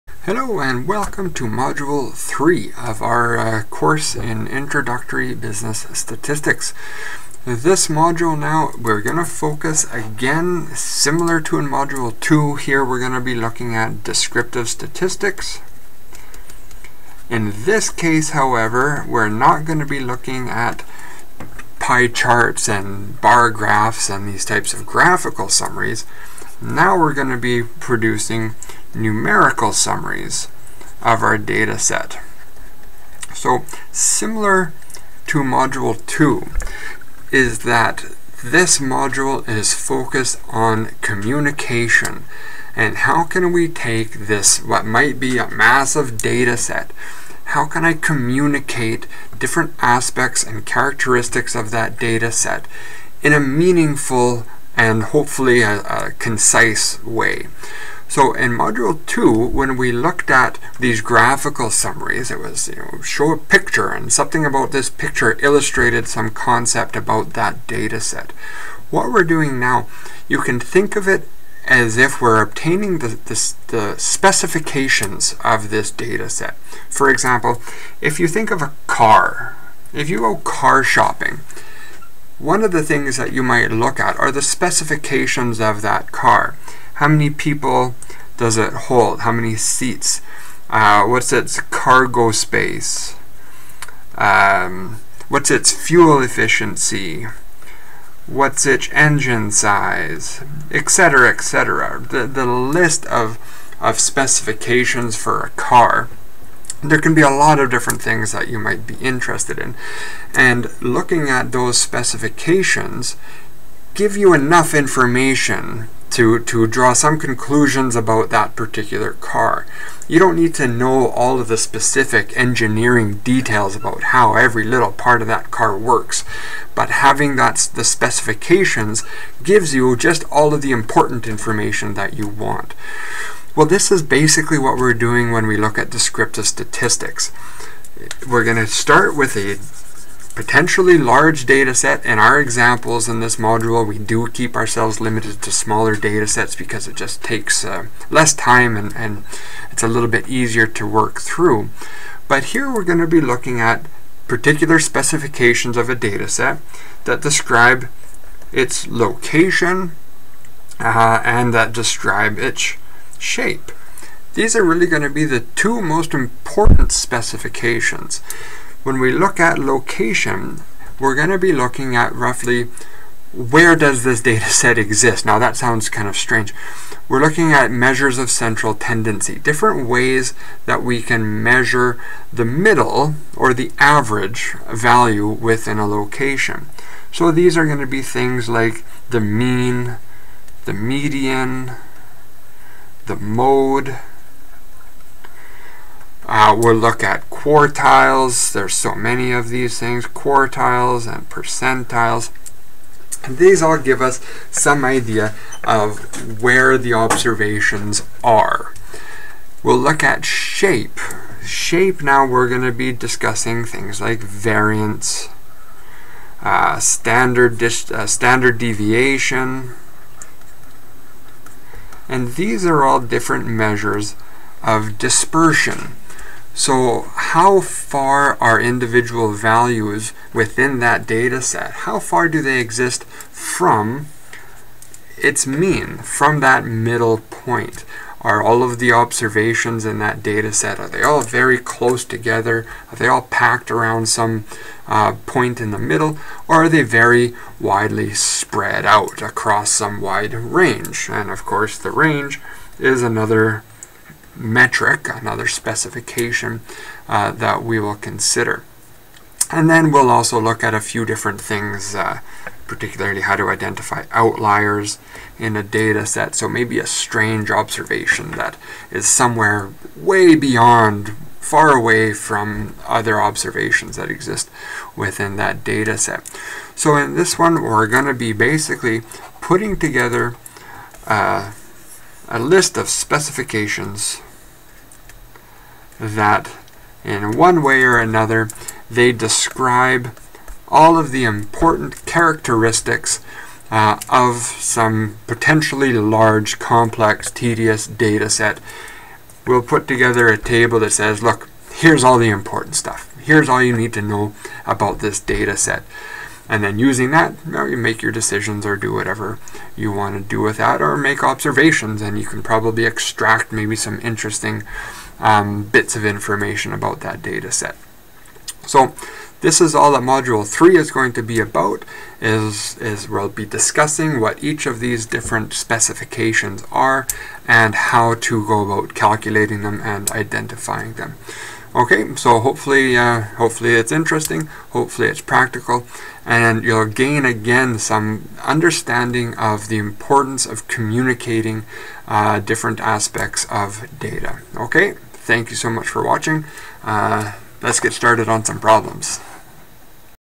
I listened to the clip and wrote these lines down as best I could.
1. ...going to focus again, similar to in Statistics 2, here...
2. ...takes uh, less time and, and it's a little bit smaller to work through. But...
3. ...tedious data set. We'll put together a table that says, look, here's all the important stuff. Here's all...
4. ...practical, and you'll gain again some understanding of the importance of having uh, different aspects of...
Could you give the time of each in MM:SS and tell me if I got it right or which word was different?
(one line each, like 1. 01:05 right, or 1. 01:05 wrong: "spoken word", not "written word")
1. 00:09 wrong: "Module", not "Statistics"
2. 02:27 wrong: "easier", not "smaller"
3. 04:57 right
4. 05:35 wrong: "communicating", not "having".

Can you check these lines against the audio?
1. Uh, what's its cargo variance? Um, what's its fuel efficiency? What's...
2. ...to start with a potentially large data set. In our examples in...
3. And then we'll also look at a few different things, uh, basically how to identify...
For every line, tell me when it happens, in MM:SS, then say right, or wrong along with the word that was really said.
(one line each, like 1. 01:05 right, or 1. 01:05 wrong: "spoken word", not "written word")
1. 01:30 wrong: "space", not "variance"
2. 02:18 right
3. 04:19 wrong: "particularly", not "basically".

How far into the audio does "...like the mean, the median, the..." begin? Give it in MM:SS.
03:08.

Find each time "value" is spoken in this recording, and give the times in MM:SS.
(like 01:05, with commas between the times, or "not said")
03:04, 03:49.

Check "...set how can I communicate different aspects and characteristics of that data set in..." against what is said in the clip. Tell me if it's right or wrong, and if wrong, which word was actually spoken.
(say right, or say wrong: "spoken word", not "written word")
right.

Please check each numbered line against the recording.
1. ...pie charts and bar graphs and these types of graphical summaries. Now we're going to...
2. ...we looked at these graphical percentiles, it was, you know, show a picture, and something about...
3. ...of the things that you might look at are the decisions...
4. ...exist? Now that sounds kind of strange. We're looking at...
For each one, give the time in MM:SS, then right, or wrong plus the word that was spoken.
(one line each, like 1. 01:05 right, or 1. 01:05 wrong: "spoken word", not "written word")
1. 00:21 right
2. 00:59 wrong: "summaries", not "percentiles"
3. 01:22 wrong: "specifications", not "decisions"
4. 02:54 right.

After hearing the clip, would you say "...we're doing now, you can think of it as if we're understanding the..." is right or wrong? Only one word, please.
wrong.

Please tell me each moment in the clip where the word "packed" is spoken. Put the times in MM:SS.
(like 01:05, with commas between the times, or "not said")
04:03.